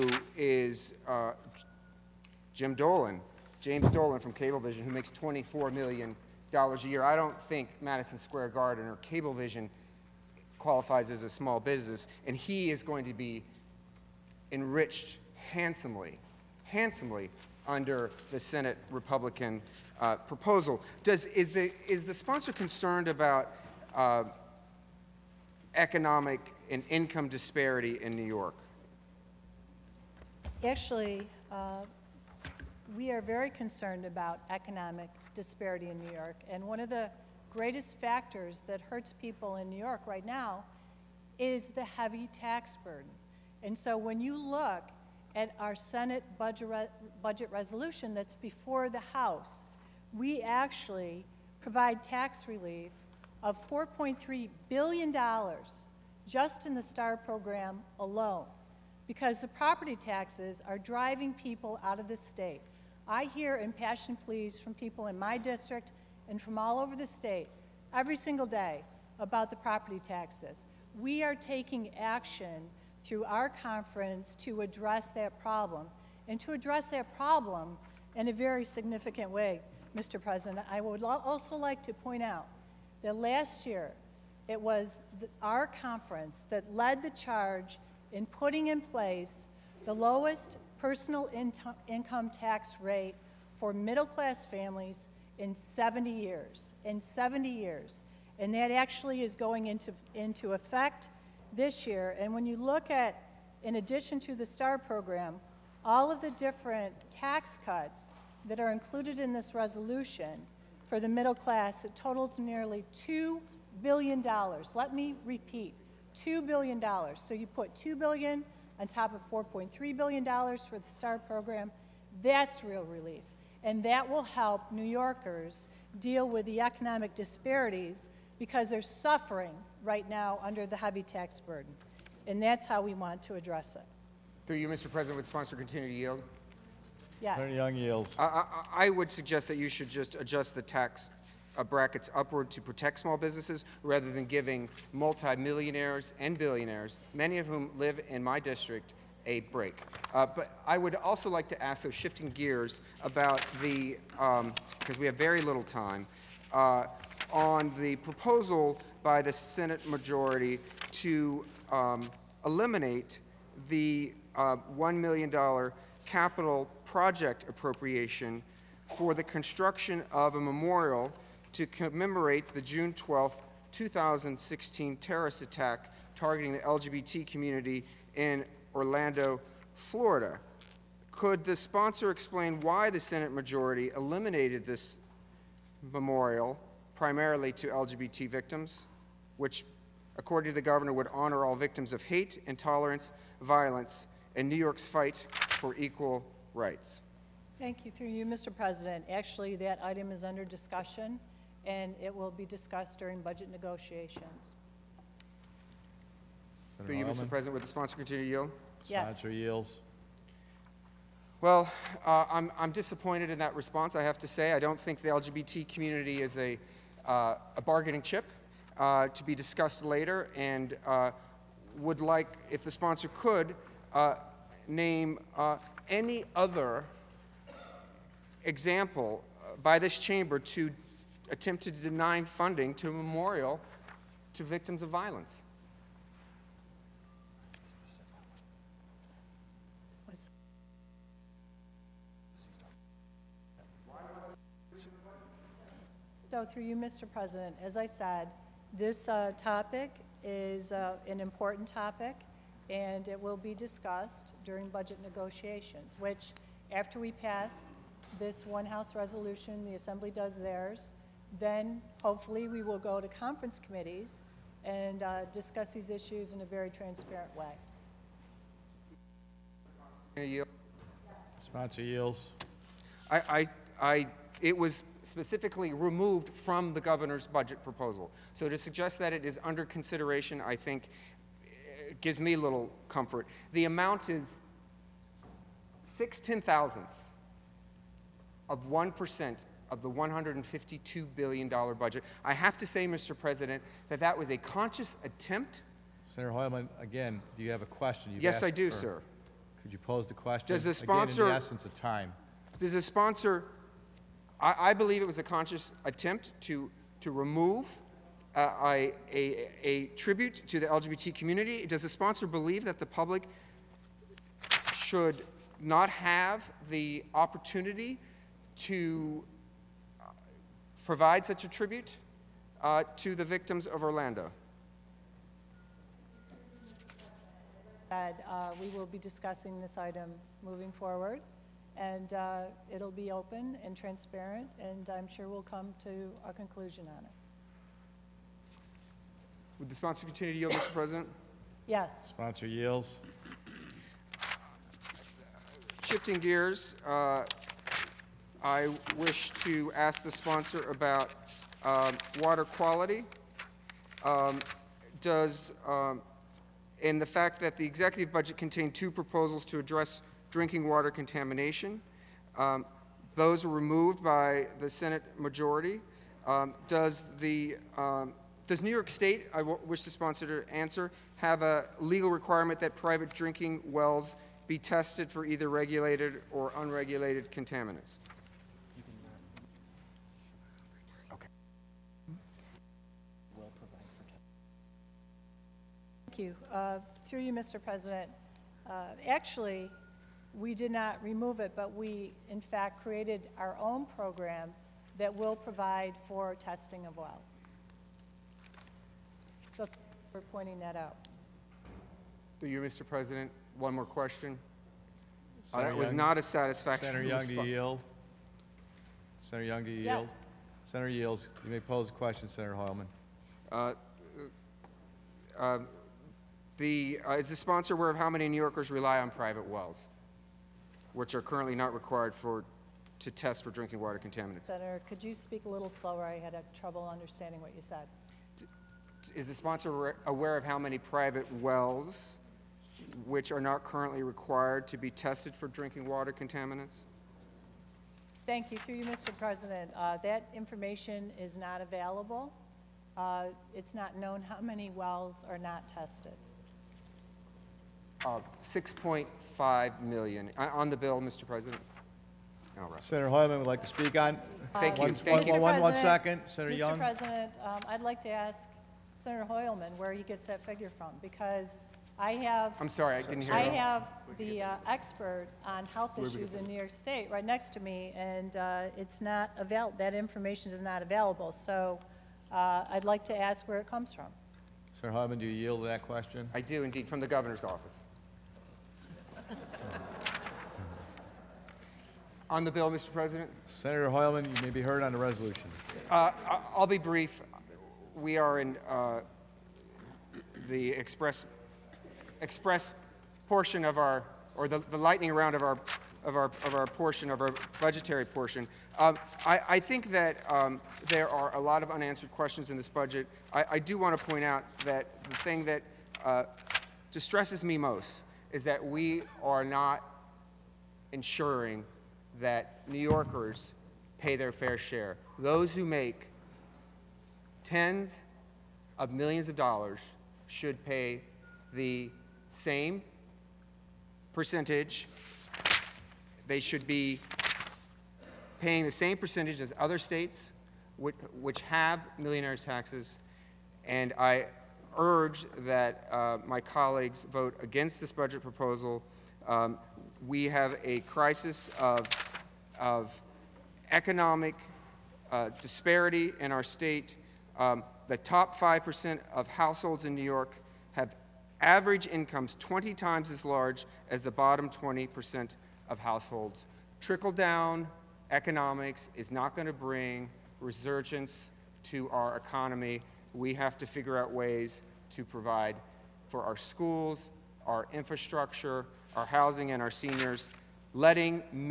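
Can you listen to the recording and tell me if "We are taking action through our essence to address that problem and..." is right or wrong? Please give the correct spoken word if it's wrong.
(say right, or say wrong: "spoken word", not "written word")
wrong: "conference", not "essence".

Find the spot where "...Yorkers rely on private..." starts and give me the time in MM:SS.
06:58.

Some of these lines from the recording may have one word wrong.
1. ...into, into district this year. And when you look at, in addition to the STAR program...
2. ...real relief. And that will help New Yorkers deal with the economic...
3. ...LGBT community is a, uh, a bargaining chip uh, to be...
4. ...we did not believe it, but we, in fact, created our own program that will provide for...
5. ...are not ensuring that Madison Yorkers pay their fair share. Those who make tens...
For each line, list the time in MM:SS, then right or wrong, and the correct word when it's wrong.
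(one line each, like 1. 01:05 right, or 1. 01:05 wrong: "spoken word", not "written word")
1. 01:39 wrong: "effect", not "district"
2. 02:02 right
3. 03:35 right
4. 06:30 wrong: "remove", not "believe"
5. 08:29 wrong: "New", not "Madison".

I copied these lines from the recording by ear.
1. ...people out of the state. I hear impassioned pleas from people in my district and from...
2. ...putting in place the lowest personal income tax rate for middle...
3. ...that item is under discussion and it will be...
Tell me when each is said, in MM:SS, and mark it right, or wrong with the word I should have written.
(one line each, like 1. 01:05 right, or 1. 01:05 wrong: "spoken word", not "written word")
1. 01:01 right
2. 01:28 right
3. 03:19 right.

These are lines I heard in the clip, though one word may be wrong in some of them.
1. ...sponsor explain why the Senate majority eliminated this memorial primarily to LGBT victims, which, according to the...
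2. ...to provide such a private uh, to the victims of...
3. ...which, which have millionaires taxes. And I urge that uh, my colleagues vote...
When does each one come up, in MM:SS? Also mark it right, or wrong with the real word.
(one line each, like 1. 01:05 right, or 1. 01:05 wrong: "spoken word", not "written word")
1. 03:01 right
2. 05:18 wrong: "tribute", not "private"
3. 08:50 right.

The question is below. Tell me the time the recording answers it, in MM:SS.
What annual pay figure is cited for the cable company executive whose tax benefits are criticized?
00:05.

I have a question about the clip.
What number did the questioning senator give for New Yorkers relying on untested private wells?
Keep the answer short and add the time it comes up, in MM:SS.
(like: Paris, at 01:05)
6.5 million, at 07:28.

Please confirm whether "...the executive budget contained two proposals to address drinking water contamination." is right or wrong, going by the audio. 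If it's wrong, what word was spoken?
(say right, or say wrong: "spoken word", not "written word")
right.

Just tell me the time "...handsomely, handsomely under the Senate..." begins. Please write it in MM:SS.
00:15.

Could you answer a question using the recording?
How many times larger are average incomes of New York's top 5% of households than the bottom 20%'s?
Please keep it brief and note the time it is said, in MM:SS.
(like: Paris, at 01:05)
20 times, at 09:12.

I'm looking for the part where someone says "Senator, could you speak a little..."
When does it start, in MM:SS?
07:04.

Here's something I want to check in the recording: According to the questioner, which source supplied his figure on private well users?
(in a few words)
the governor's office.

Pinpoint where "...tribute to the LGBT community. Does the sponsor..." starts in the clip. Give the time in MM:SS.
05:09.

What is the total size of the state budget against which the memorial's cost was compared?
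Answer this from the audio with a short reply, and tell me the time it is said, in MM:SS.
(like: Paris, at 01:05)
$152 billion, at 04:49.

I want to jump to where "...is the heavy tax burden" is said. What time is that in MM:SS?
00:41.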